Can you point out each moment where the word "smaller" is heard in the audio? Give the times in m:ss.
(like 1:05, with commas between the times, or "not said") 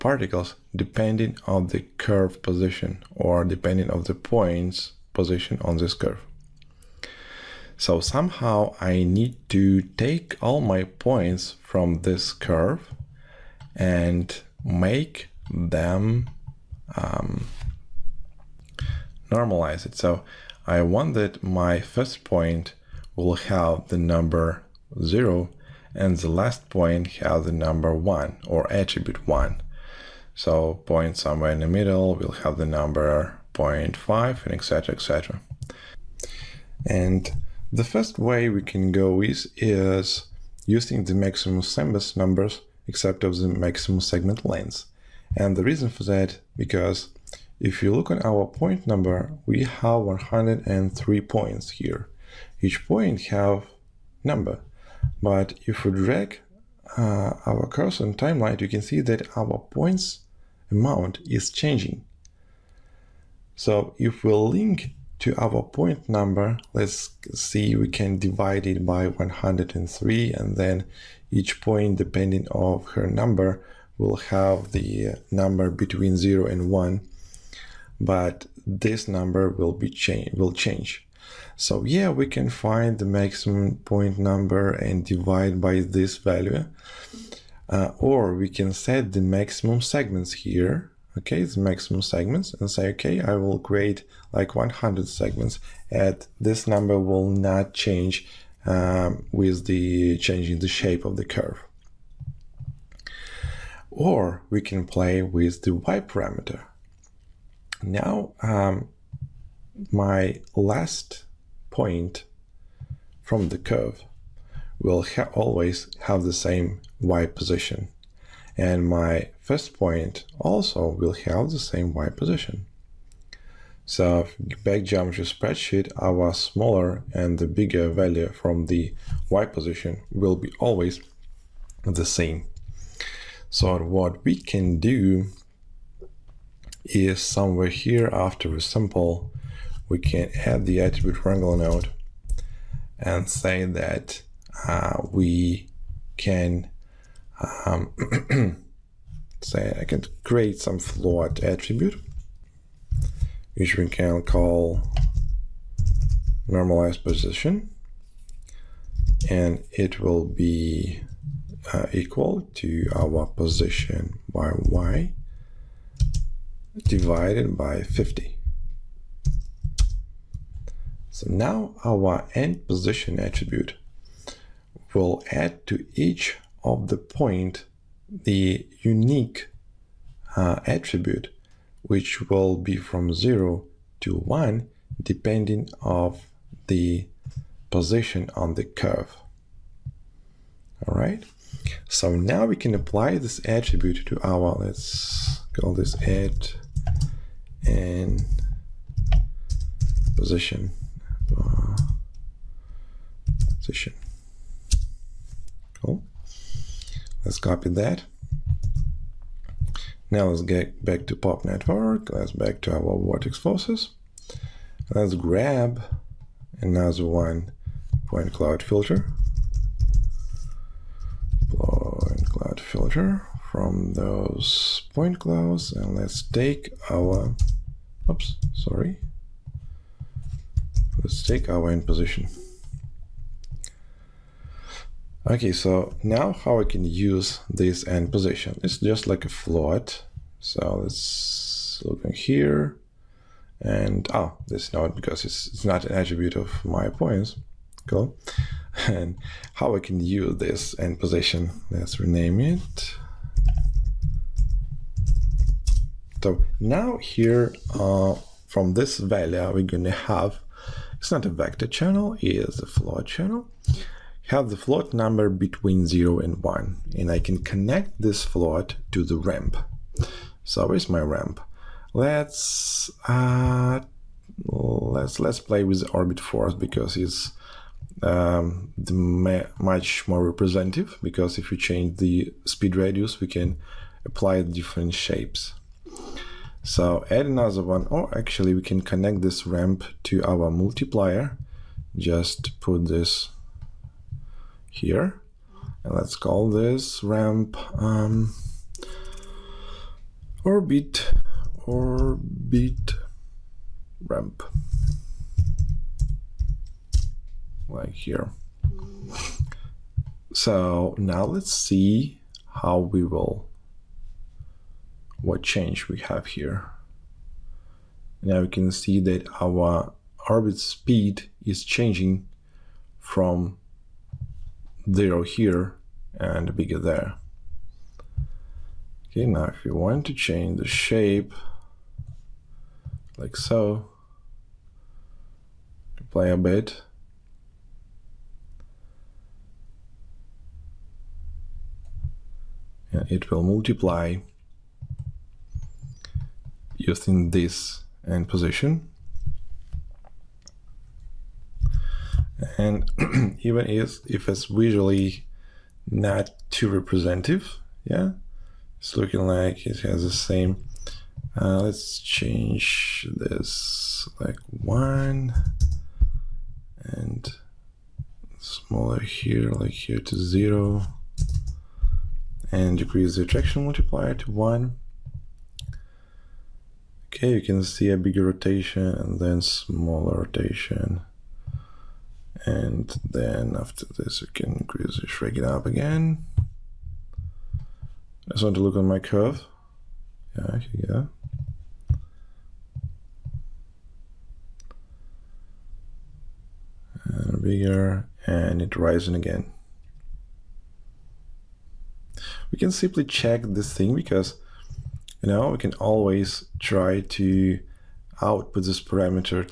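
2:06, 6:08, 6:19.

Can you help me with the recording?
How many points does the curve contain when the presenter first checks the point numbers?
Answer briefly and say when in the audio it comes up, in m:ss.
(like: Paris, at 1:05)
103, at 0:50.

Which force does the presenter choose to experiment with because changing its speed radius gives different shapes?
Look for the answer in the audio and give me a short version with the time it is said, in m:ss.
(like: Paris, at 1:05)
Orbit force, at 4:35.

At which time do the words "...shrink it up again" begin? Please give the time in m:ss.
6:25.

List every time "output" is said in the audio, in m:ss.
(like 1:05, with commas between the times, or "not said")
6:48.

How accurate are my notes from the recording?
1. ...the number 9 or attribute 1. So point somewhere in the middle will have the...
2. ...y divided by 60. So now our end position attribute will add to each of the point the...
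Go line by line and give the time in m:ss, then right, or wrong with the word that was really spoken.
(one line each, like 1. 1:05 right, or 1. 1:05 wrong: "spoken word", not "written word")
1. 0:27 wrong: "1", not "9"
2. 2:44 wrong: "50", not "60".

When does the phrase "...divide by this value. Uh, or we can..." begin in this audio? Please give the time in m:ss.
1:25.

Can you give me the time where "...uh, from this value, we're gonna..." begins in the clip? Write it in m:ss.
4:17.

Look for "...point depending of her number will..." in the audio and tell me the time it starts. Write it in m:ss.
1:11.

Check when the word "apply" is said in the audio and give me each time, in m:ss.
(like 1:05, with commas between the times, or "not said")
3:12, 4:44.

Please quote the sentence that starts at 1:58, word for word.
And my first point also will have the same y position.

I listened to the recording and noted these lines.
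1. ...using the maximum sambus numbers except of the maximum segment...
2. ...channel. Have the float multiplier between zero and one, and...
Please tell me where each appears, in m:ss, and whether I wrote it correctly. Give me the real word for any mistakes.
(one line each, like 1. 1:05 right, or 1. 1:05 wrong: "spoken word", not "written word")
1. 0:40 right
2. 4:23 wrong: "number", not "multiplier".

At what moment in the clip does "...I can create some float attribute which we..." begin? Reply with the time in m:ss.
2:29.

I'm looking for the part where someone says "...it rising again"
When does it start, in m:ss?
6:38.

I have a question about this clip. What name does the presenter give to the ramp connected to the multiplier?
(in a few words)
Orbit ramp.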